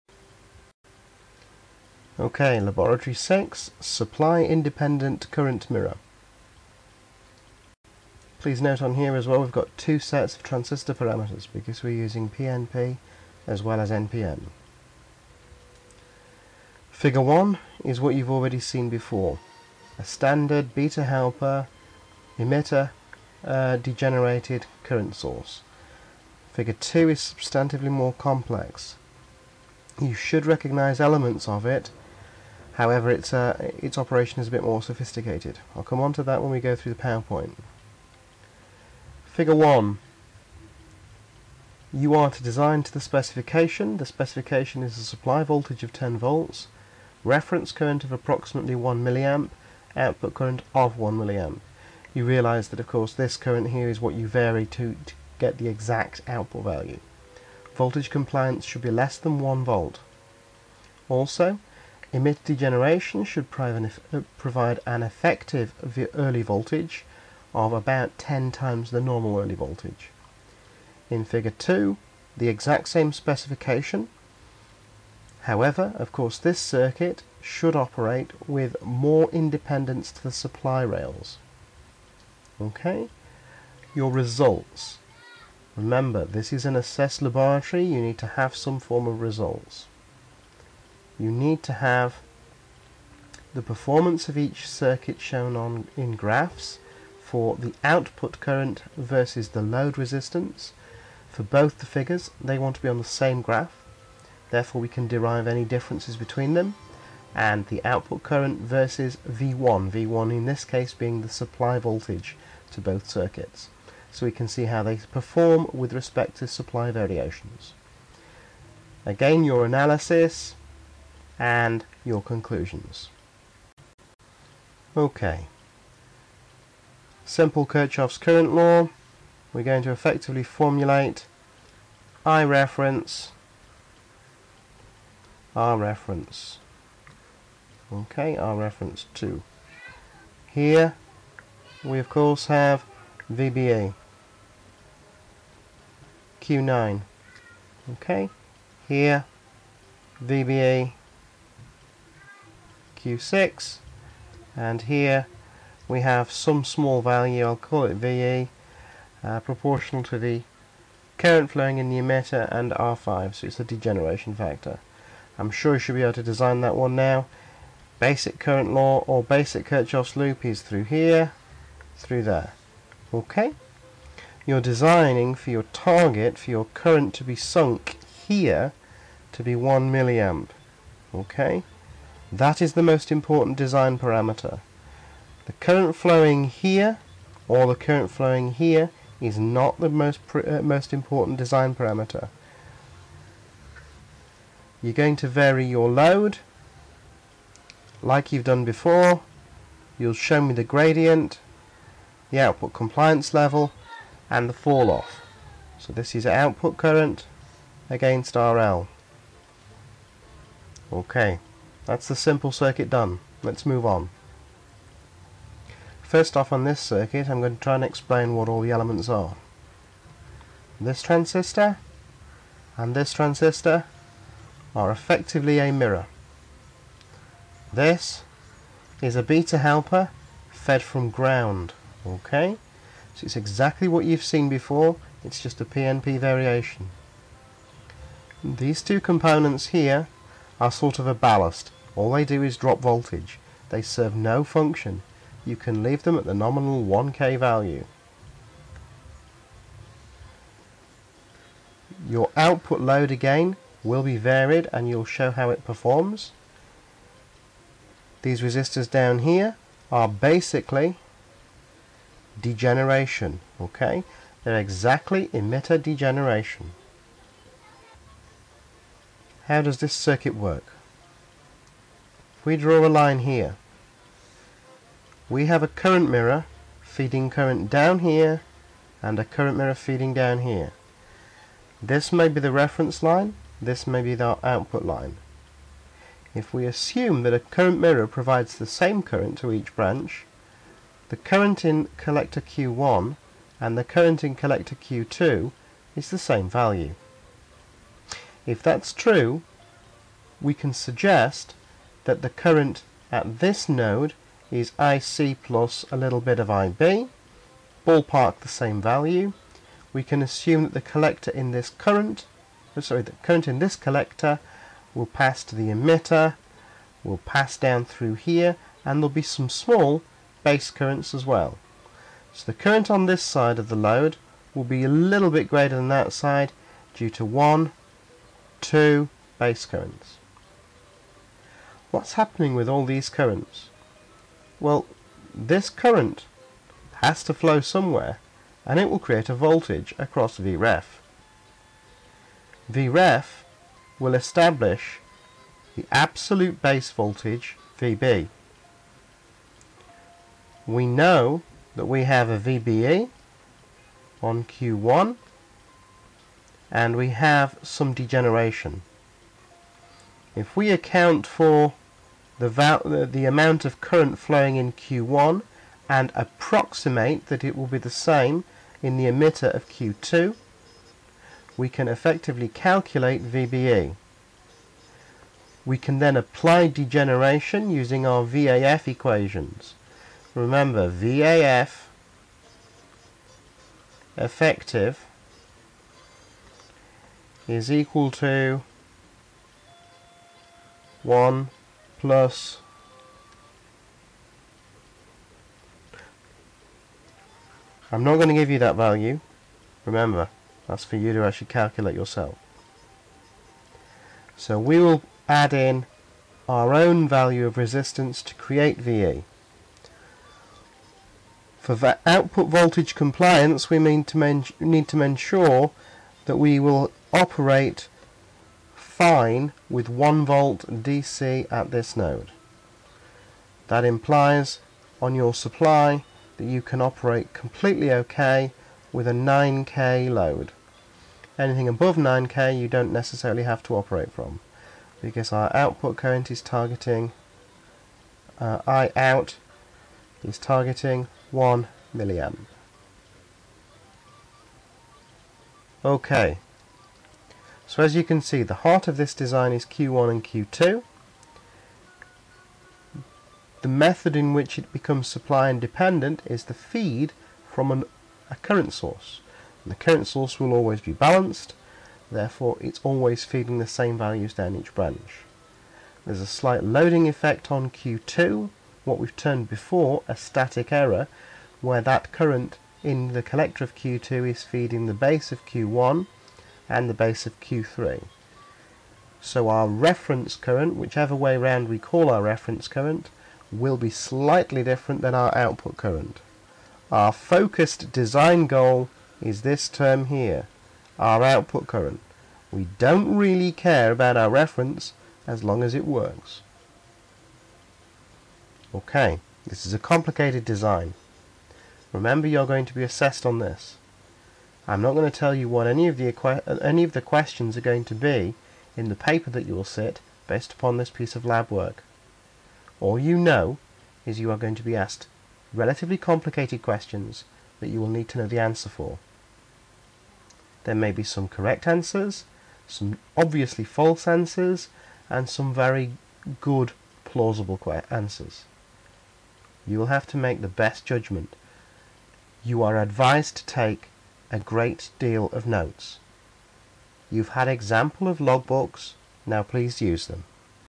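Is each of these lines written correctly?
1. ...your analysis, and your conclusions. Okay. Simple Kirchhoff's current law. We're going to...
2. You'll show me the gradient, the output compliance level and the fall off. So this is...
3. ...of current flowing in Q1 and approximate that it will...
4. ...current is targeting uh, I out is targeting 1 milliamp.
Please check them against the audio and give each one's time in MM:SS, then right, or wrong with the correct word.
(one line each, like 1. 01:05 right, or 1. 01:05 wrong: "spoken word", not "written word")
1. 01:59 right
2. 03:19 right
3. 06:03 right
4. 07:15 right.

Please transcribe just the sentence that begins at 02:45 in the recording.
I'm sure you should be able to design that one now.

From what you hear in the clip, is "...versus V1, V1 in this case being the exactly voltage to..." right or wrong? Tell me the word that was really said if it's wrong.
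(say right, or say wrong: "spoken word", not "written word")
wrong: "supply", not "exactly".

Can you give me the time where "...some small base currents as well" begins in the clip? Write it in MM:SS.
05:19.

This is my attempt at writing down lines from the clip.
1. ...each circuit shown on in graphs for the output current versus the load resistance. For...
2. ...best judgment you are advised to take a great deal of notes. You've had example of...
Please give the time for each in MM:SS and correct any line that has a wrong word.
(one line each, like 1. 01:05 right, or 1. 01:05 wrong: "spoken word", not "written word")
1. 01:34 right
2. 08:50 right.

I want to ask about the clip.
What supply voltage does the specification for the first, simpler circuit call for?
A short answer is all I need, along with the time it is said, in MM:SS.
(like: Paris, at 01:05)
10 volts, at 00:45.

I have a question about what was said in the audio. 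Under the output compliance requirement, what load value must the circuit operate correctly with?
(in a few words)
9k.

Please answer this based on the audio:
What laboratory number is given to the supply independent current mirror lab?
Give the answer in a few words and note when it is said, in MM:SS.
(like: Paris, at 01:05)
6, at 00:02.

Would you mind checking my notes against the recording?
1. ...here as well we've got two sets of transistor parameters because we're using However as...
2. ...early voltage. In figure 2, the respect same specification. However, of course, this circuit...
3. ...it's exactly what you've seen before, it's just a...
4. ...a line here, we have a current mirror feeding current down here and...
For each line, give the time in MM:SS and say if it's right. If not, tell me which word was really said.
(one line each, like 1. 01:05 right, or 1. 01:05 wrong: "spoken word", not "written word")
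1. 00:08 wrong: "PNP", not "However"
2. 01:09 wrong: "exact", not "respect"
3. 03:53 right
4. 04:32 right.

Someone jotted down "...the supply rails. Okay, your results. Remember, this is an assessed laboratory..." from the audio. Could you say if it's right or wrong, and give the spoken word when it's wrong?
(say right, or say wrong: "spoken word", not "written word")
right.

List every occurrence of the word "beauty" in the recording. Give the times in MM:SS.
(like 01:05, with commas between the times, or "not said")
not said.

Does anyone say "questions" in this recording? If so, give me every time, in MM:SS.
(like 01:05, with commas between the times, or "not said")
08:27, 08:36.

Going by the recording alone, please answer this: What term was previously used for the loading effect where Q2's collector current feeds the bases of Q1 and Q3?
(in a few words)
static error.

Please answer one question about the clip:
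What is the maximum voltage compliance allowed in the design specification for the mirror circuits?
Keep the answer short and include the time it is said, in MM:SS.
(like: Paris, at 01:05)
less than 1 volt, at 00:58.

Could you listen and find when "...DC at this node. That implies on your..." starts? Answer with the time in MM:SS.
07:00.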